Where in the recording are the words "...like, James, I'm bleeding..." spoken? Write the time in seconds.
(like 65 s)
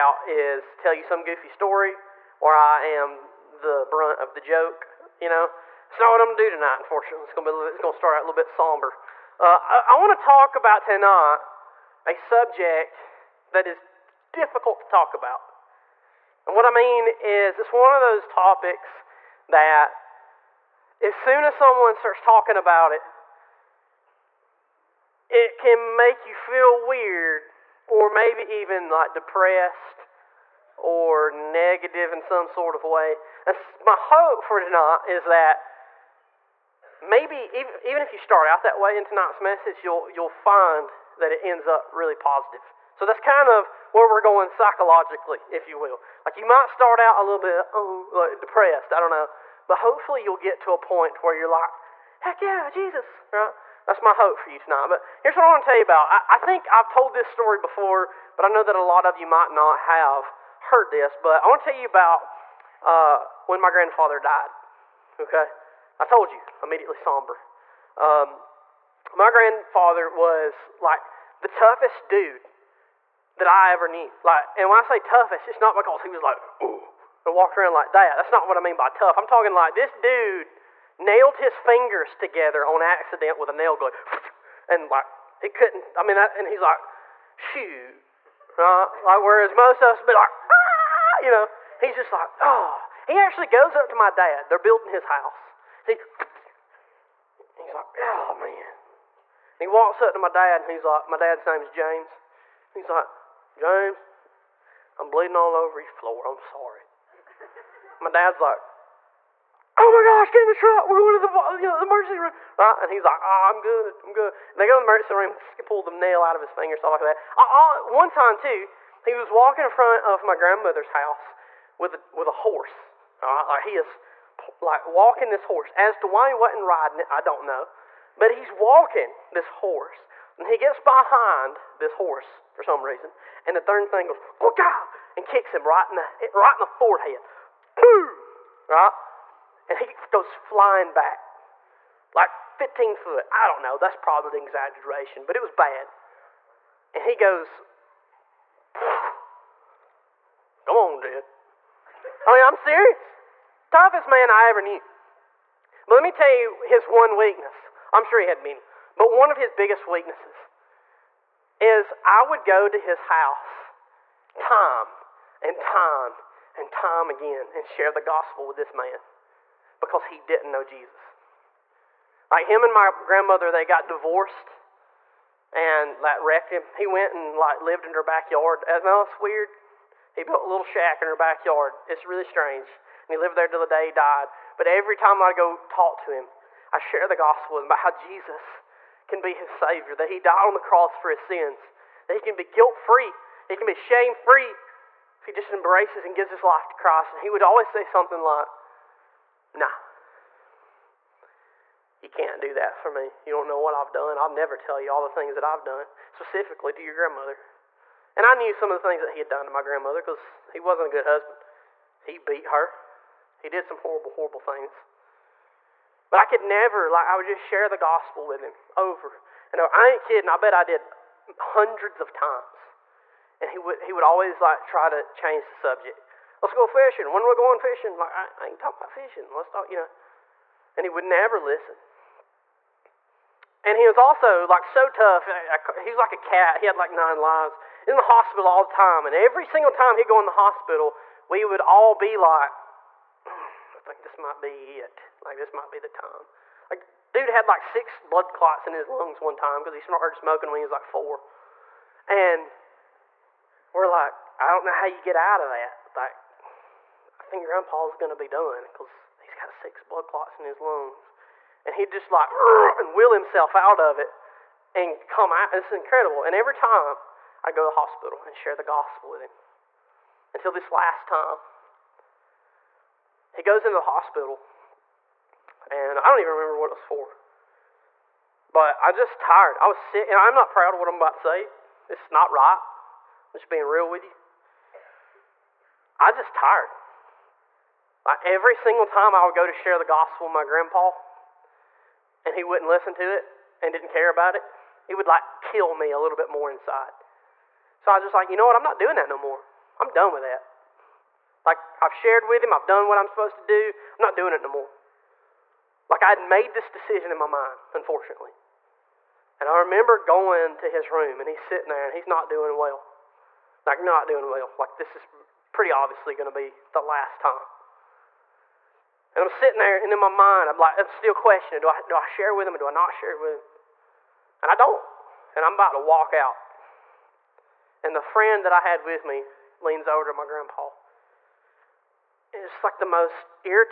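102 s.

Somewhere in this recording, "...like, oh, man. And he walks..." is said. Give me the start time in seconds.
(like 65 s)
97 s.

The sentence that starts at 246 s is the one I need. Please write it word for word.
Like dude had like six blood clots in his lungs one time because he started smoking when he was like four.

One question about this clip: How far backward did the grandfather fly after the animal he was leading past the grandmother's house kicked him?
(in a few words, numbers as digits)
15 foot.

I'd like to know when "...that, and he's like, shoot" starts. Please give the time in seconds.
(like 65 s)
86 s.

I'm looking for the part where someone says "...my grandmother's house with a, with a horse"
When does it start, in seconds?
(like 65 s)
120 s.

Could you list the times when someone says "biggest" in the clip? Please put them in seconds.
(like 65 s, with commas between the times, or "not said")
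159 s.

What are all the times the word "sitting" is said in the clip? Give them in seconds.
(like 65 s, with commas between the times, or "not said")
311 s, 319 s.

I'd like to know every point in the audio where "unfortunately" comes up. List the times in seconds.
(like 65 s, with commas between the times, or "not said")
6 s, 307 s.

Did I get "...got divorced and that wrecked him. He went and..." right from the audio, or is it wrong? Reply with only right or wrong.
right.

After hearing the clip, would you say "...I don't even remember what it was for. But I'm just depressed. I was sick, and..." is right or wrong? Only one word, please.
wrong.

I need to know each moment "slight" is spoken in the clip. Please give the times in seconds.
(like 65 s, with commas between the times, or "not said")
not said.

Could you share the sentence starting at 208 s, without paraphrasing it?
And I knew some of the things that he had done to my grandmother because he wasn't a good husband.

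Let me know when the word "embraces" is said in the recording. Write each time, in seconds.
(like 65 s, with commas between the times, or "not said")
195 s.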